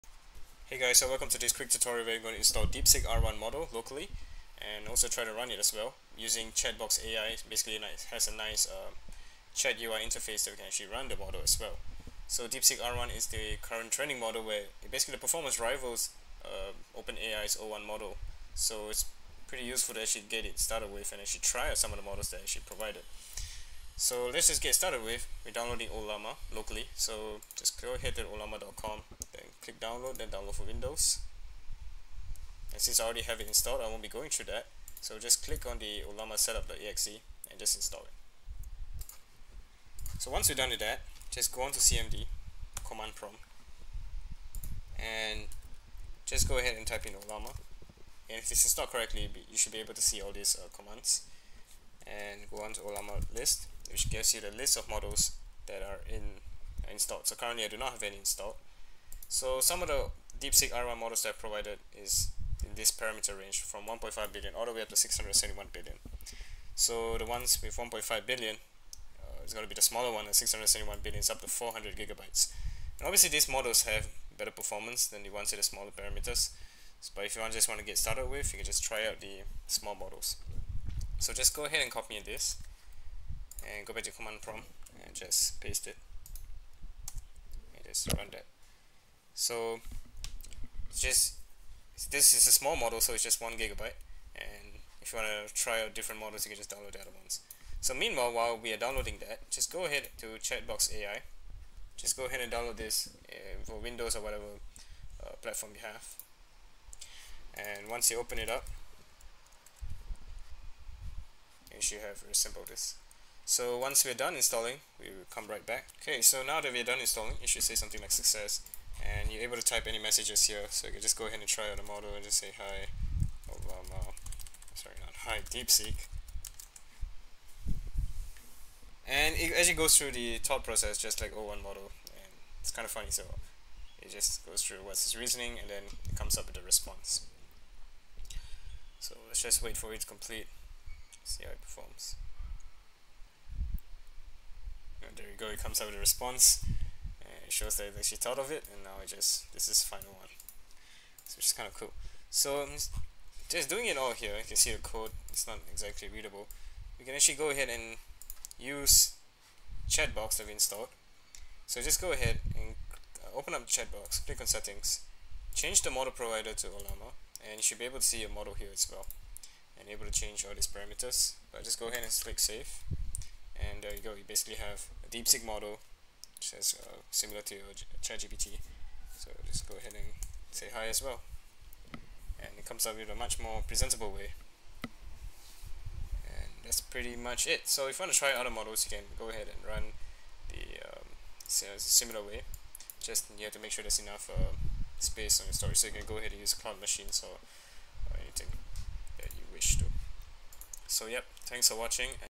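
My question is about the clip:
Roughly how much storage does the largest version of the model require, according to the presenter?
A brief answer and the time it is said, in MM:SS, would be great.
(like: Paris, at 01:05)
400 gigabytes, at 01:11.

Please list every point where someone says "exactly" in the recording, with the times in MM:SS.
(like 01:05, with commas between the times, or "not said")
02:35.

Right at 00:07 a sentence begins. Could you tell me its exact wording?
Basically, it has a nice um, chat UI interface that we can actually run the model as well.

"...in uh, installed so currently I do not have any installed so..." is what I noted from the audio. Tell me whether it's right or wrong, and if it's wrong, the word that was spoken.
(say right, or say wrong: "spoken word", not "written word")
right.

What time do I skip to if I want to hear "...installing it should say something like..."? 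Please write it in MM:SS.
01:56.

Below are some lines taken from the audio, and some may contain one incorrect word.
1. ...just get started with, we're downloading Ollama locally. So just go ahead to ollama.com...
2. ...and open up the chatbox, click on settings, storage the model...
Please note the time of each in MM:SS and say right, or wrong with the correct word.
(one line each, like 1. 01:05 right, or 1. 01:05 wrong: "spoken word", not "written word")
1. 00:24 right
2. 02:42 wrong: "change", not "storage".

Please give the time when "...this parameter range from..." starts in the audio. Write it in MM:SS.
01:02.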